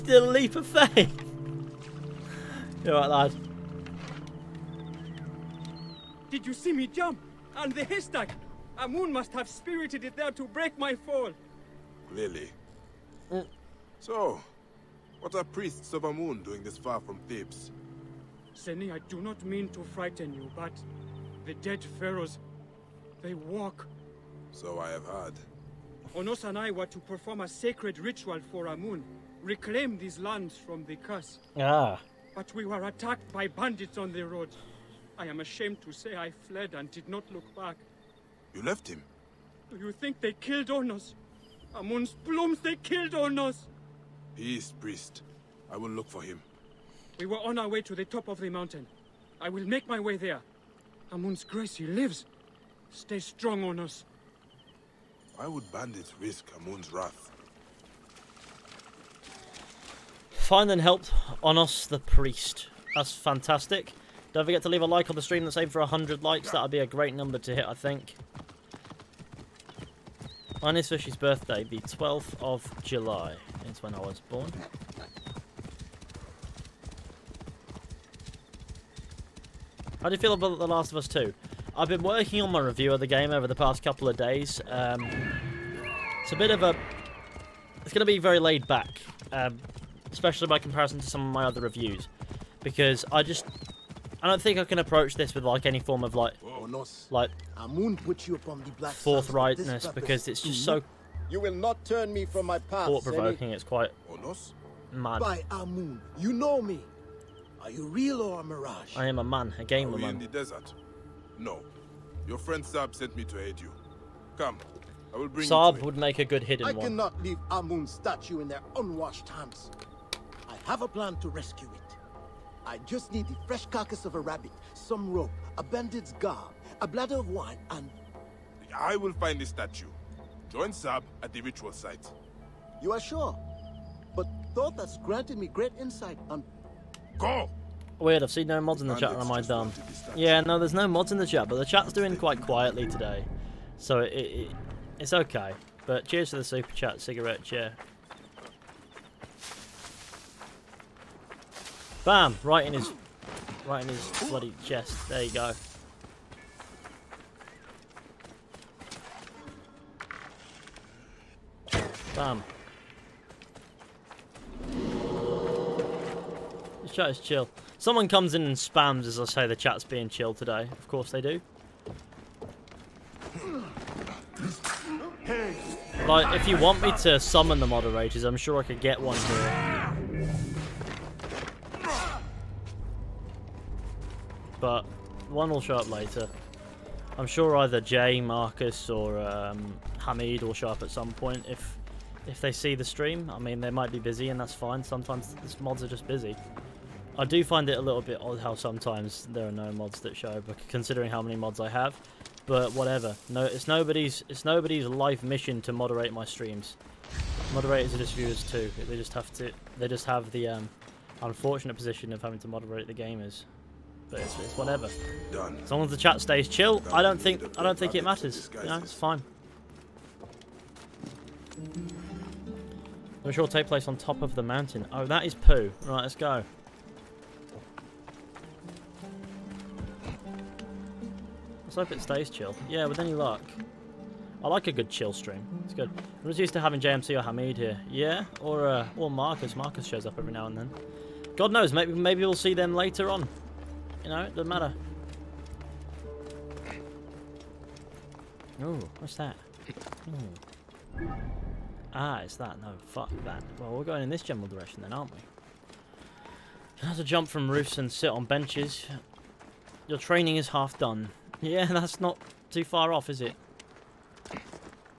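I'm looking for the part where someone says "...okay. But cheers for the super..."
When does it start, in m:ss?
2:25.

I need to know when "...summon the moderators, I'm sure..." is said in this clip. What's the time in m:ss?
2:57.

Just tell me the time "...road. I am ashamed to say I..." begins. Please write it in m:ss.
0:34.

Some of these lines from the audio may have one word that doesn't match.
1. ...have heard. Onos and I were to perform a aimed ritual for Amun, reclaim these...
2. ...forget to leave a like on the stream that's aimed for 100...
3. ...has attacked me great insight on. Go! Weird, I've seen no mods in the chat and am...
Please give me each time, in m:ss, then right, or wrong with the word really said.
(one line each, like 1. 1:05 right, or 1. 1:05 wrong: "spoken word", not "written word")
1. 0:24 wrong: "sacred", not "aimed"
2. 1:04 right
3. 2:14 wrong: "granted", not "attacked".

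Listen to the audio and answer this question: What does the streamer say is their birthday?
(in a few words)
12th of July.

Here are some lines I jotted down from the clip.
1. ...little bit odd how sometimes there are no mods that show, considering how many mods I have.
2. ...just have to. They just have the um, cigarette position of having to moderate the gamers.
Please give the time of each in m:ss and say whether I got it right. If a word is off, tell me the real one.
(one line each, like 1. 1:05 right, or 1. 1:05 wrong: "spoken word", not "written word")
1. 3:17 right
2. 3:28 wrong: "unfortunate", not "cigarette".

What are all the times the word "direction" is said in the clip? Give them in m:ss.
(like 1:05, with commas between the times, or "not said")
4:14.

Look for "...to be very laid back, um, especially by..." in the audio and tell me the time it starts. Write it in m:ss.
1:28.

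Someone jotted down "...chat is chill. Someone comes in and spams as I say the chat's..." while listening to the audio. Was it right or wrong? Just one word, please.
right.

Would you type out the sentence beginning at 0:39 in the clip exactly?
Do you think they killed Onos?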